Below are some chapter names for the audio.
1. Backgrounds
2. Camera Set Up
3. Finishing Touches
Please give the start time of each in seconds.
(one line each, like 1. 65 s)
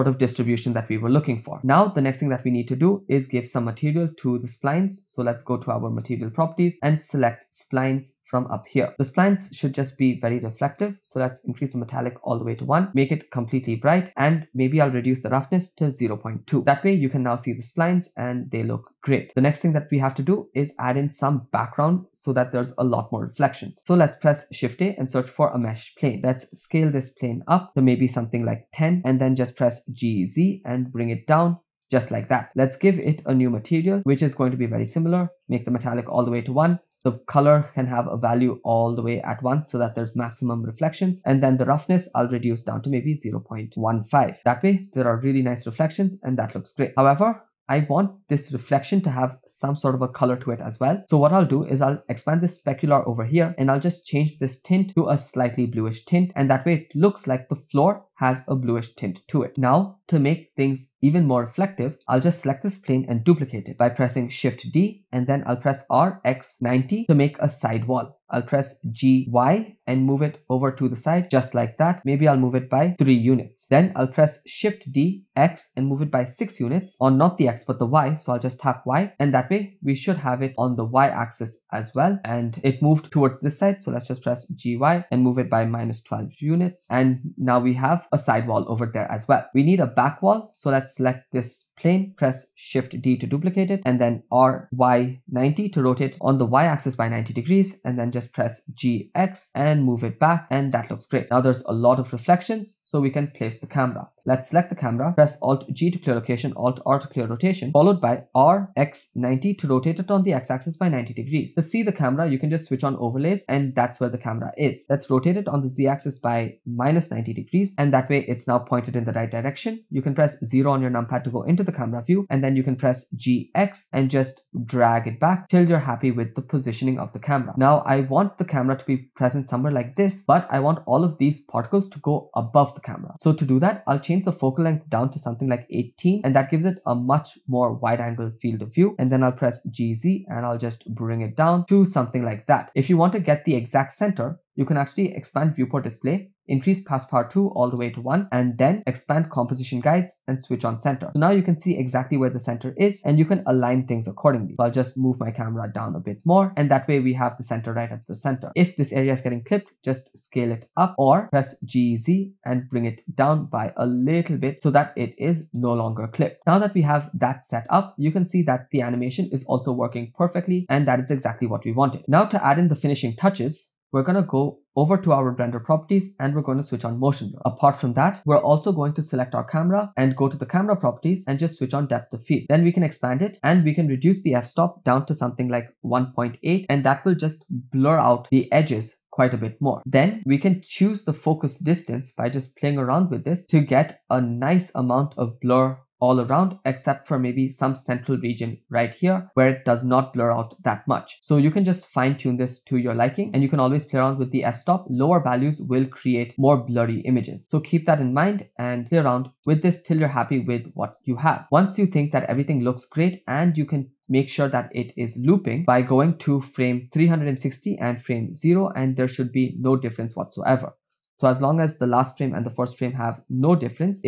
1. 18 s
2. 98 s
3. 171 s.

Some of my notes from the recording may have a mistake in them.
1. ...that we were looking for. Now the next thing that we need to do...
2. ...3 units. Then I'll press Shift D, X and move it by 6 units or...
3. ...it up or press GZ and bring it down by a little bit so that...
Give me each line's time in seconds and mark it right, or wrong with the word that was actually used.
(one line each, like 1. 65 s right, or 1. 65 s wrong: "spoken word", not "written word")
1. 0 s right
2. 72 s right
3. 160 s right.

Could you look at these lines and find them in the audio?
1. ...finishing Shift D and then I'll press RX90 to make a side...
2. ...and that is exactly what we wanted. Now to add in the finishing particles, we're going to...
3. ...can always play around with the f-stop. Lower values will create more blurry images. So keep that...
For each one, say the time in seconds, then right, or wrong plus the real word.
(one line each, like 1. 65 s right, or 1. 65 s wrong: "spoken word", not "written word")
1. 63 s wrong: "pressing", not "finishing"
2. 170 s wrong: "touches", not "particles"
3. 203 s right.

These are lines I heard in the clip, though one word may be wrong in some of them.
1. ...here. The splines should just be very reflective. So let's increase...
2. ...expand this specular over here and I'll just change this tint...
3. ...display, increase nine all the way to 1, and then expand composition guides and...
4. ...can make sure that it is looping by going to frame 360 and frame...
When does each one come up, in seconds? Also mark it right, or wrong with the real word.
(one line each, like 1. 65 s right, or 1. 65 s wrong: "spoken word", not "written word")
1. 8 s right
2. 52 s right
3. 145 s wrong: "two", not "nine"
4. 213 s right.